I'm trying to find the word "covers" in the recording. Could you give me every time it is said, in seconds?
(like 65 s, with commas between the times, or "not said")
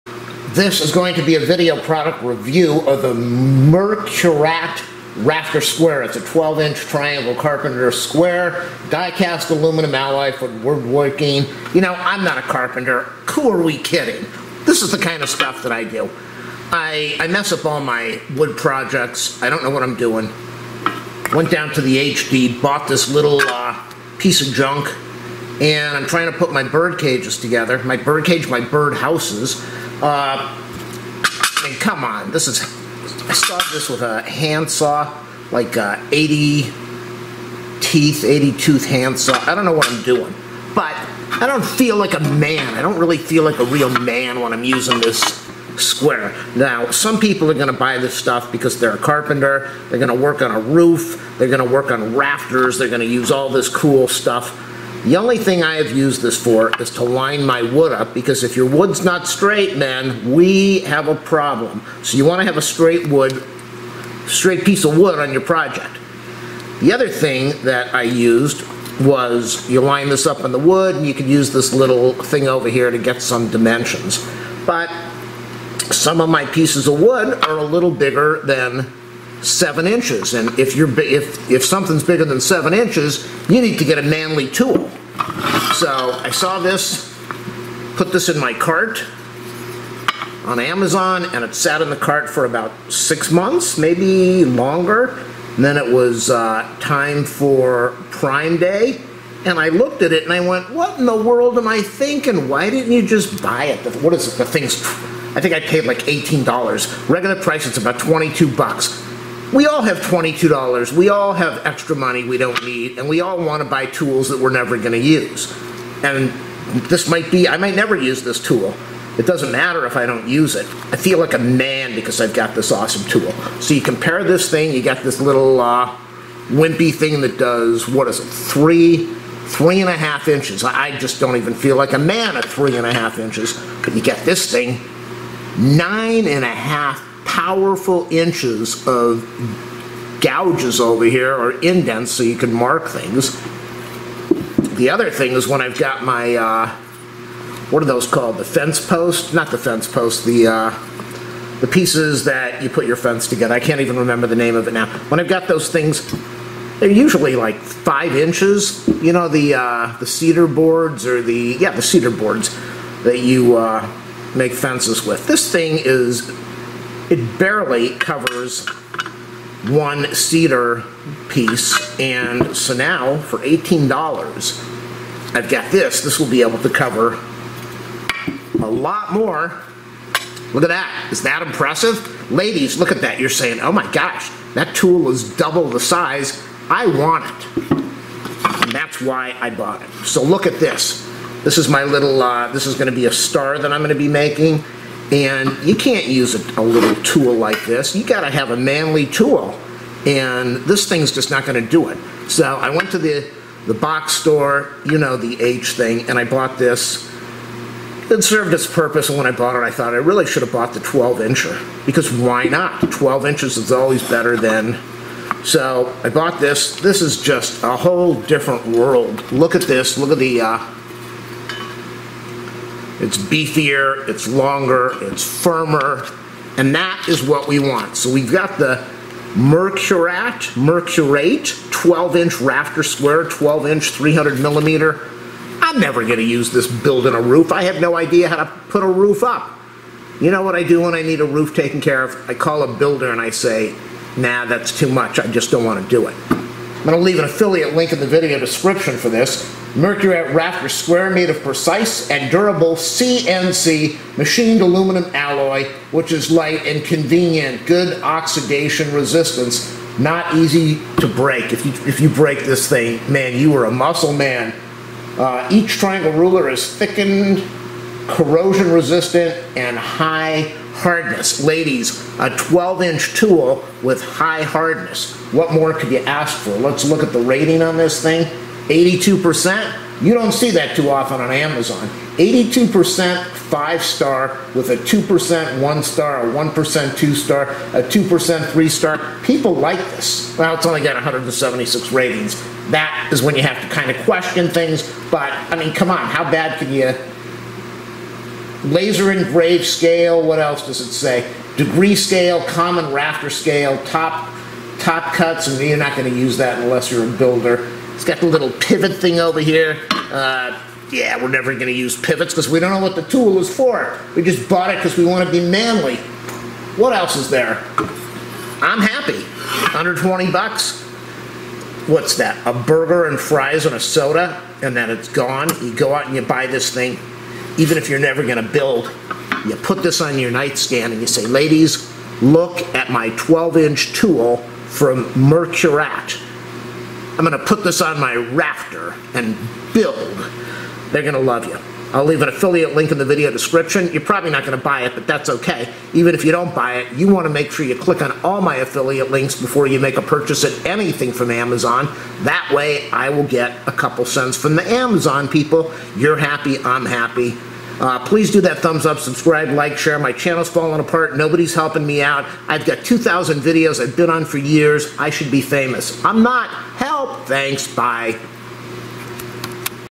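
167 s, 176 s.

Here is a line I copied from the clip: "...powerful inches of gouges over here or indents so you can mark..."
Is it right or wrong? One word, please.
right.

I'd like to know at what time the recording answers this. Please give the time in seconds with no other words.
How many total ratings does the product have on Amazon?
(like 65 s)
290 s.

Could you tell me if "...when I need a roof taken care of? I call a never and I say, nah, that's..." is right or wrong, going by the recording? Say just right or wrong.
wrong.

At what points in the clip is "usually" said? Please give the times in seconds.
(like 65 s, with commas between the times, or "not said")
156 s.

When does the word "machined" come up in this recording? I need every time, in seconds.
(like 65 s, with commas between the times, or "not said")
254 s.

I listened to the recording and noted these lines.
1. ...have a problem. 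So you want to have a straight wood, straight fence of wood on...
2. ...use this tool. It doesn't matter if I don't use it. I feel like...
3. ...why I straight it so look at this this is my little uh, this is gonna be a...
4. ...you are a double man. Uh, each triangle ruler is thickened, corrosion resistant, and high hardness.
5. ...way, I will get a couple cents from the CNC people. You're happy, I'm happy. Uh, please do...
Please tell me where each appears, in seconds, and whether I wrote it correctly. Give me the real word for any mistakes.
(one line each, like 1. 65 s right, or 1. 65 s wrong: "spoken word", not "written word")
1. 60 s wrong: "piece", not "fence"
2. 117 s right
3. 189 s wrong: "bought", not "straight"
4. 263 s wrong: "muscle", not "double"
5. 352 s wrong: "Amazon", not "CNC".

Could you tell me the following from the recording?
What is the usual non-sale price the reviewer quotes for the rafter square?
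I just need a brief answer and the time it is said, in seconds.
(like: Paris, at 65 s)
$22, at 107 s.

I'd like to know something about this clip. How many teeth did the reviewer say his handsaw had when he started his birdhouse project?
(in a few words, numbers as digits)
80.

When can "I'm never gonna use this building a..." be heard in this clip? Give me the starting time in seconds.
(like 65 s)
235 s.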